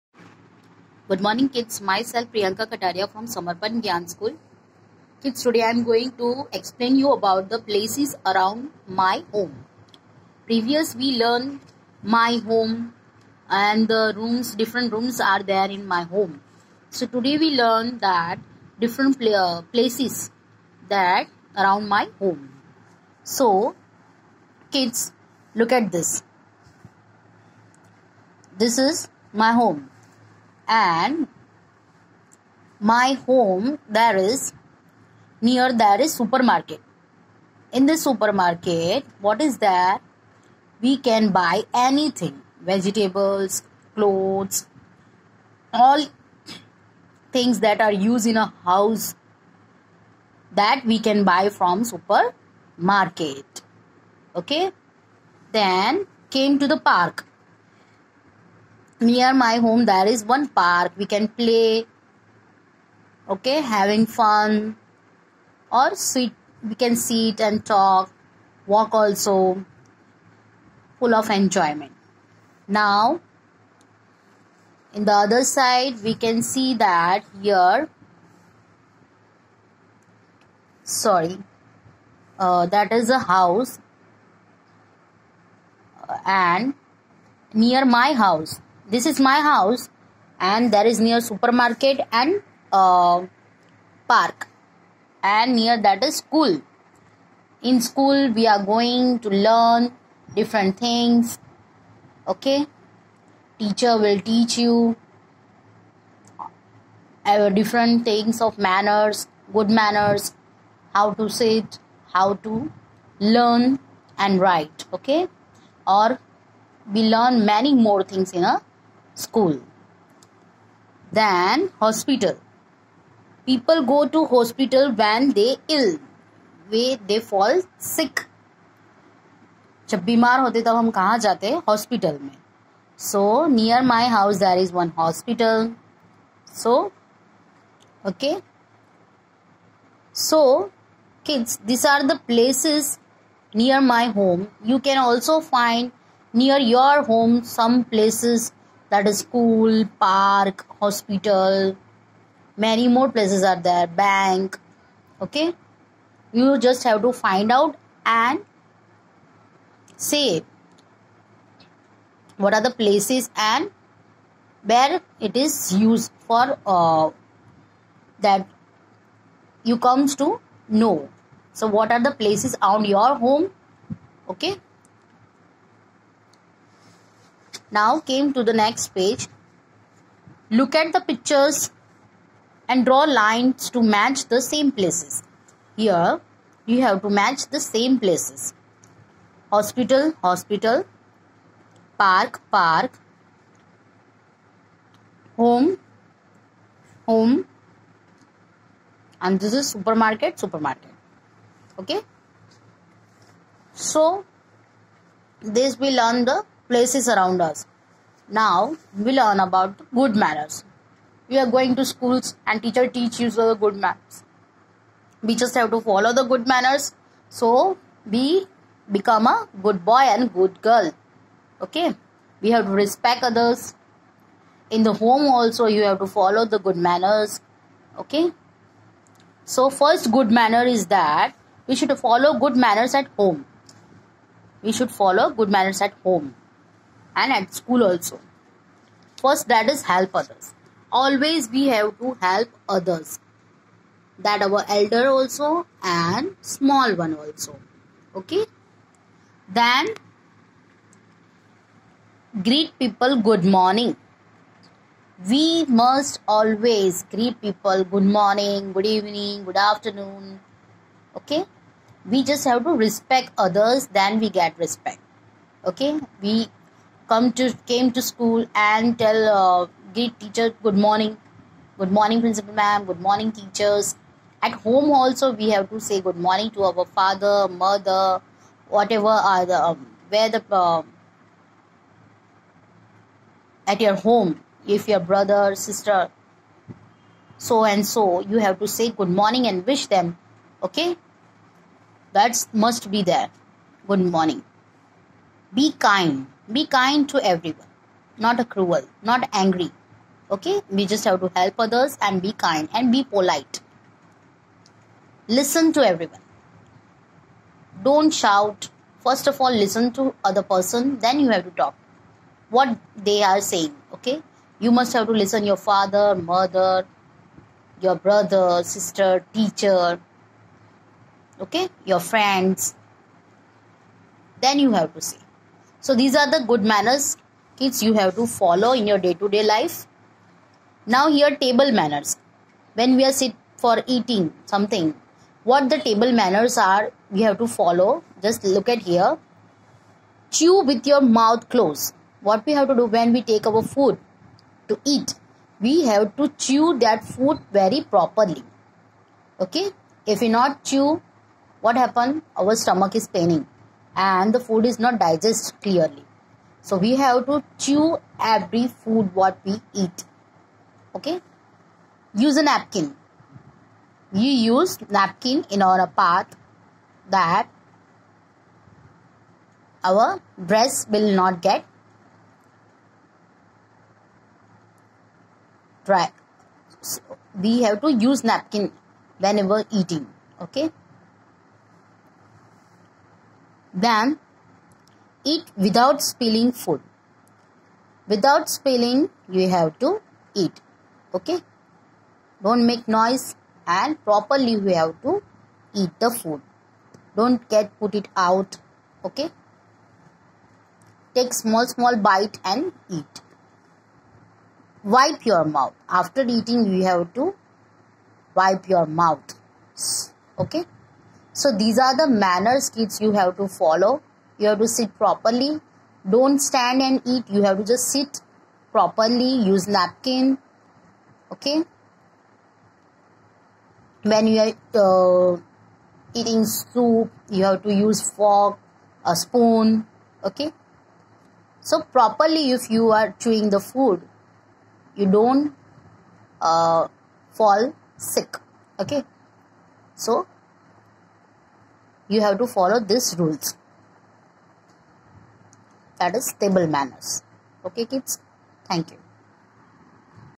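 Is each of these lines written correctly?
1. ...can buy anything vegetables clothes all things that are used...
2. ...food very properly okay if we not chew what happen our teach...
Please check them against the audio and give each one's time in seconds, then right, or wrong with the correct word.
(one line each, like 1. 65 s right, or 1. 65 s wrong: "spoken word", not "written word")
1. 41 s right
2. 347 s wrong: "stomach", not "teach".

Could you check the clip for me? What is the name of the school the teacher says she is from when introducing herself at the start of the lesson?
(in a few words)
Samarpan Gnyan School.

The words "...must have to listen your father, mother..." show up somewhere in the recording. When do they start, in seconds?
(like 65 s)
314 s.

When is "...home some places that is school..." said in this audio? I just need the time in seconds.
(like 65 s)
147 s.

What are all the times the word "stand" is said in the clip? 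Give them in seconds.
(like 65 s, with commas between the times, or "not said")
416 s.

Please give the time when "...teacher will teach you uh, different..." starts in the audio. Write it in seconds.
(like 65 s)
103 s.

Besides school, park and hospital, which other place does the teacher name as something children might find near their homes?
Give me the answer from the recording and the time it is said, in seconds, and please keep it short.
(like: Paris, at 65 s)
Bank, at 153 s.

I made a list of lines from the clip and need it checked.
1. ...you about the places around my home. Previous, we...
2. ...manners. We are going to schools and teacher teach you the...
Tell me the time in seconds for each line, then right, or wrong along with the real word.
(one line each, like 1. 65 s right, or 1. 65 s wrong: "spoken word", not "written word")
1. 7 s right
2. 210 s right.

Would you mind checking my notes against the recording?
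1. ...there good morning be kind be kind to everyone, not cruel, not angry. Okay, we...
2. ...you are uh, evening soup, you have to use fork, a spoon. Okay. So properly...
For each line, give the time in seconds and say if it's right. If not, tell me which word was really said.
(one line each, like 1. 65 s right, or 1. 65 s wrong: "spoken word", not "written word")
1. 293 s right
2. 424 s wrong: "eating", not "evening".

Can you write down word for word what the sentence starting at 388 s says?
Without spilling, you have to eat.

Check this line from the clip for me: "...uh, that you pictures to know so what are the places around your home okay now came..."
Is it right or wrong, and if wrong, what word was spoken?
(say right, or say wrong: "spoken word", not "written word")
wrong: "comes", not "pictures".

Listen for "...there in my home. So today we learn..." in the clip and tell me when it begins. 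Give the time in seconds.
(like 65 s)
15 s.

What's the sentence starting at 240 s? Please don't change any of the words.
Always we have to help others.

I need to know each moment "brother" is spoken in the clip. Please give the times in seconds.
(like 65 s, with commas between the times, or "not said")
285 s, 317 s.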